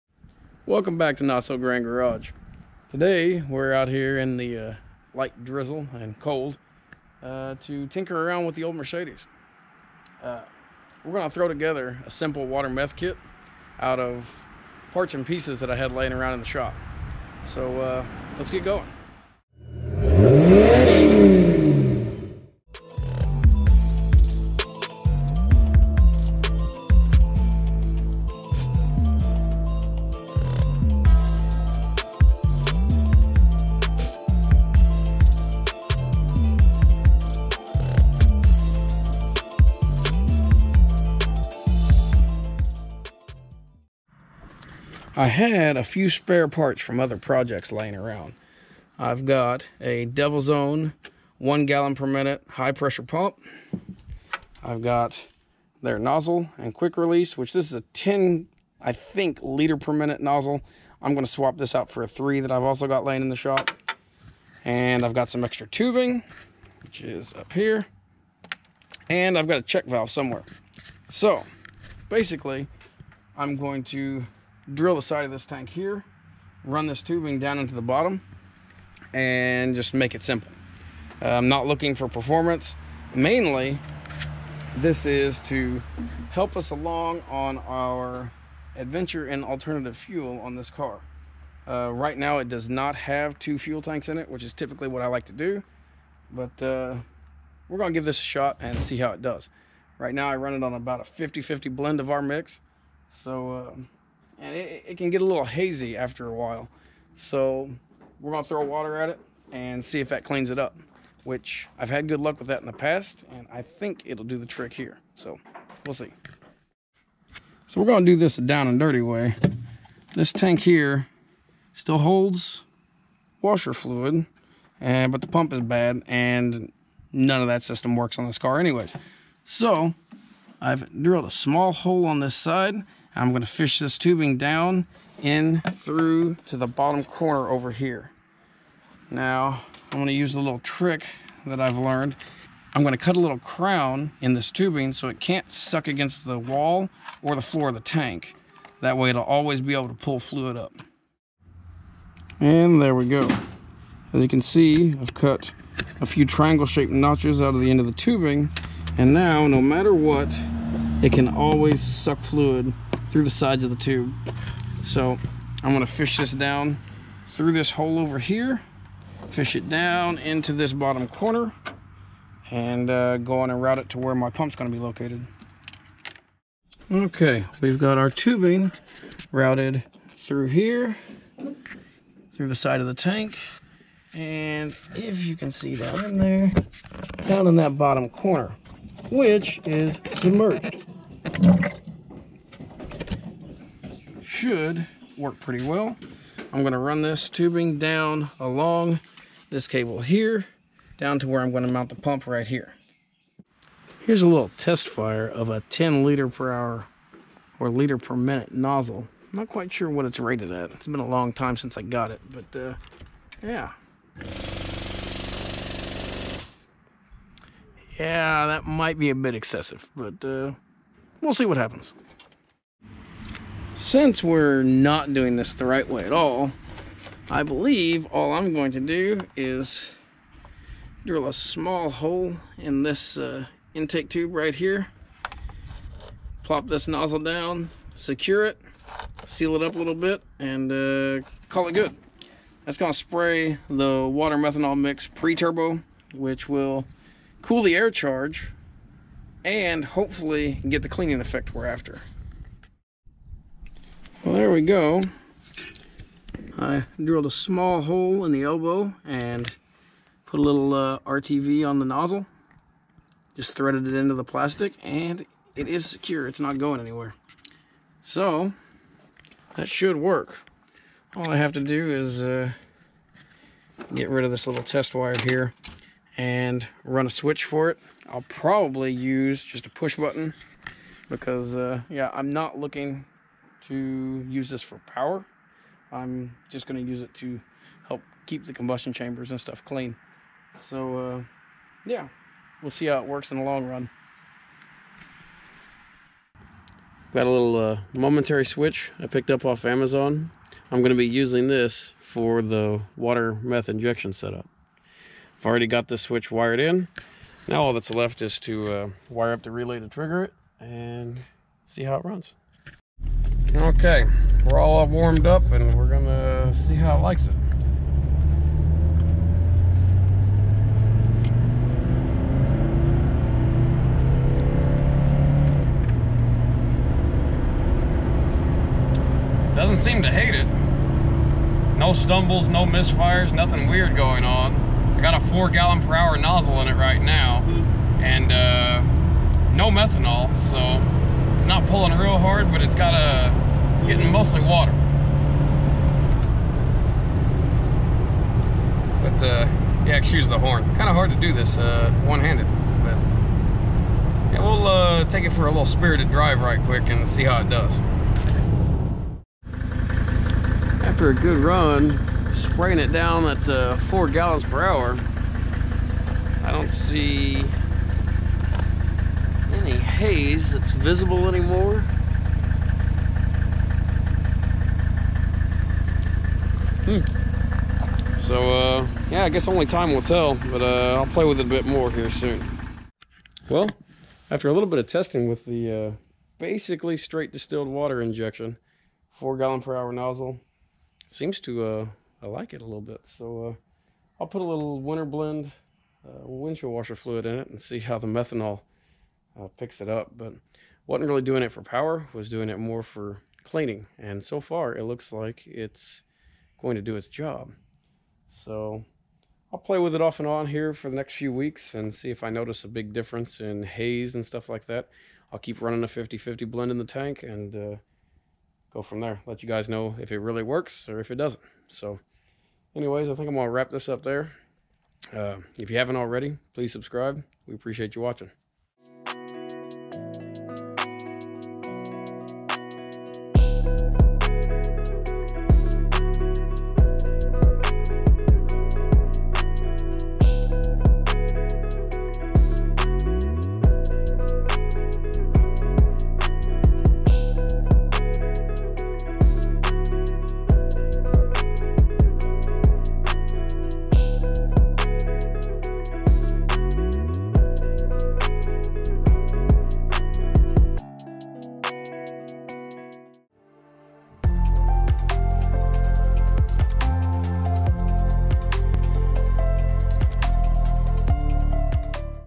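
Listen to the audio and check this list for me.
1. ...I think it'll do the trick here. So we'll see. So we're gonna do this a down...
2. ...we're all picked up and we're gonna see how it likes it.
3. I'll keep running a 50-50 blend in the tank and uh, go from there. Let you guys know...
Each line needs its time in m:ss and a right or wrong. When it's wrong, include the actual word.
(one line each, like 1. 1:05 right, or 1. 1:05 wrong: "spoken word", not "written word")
1. 1:53 right
2. 5:14 wrong: "warmed", not "picked"
3. 6:55 right.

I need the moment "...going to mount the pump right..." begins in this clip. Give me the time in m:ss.
3:21.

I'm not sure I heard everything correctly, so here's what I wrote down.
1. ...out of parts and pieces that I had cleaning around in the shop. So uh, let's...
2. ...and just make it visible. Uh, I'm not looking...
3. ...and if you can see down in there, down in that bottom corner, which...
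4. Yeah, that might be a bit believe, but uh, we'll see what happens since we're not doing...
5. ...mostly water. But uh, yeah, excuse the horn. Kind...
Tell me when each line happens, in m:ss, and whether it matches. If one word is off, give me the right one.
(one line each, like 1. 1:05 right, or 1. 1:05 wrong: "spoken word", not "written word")
1. 0:13 wrong: "laying", not "cleaning"
2. 1:19 wrong: "simple", not "visible"
3. 3:04 right
4. 3:37 wrong: "excessive", not "believe"
5. 5:44 right.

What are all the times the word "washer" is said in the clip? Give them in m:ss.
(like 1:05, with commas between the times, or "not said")
2:03, 6:36.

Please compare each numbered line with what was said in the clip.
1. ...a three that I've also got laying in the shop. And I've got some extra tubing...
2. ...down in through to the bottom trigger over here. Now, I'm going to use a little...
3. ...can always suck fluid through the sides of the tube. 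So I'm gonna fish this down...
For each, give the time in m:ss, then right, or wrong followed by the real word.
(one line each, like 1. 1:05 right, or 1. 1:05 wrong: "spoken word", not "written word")
1. 1:02 right
2. 2:14 wrong: "corner", not "trigger"
3. 2:41 right.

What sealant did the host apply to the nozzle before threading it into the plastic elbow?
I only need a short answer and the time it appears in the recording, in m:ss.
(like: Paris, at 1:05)
RTV, at 4:20.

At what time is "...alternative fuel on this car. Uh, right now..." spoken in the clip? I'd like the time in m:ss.
1:29.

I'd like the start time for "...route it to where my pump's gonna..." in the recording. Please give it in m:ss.
2:53.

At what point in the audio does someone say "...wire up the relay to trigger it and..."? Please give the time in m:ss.
5:09.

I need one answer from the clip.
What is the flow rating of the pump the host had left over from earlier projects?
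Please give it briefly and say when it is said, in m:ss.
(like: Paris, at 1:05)
1 gallon per minute, at 0:51.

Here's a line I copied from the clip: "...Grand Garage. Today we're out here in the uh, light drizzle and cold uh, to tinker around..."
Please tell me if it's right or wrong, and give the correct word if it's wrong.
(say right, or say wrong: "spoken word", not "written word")
right.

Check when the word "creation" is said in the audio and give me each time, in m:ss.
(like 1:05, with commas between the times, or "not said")
not said.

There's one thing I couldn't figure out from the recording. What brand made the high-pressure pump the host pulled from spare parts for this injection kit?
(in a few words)
Devil's Own.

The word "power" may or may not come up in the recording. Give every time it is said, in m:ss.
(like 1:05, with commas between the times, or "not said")
4:44, 6:41.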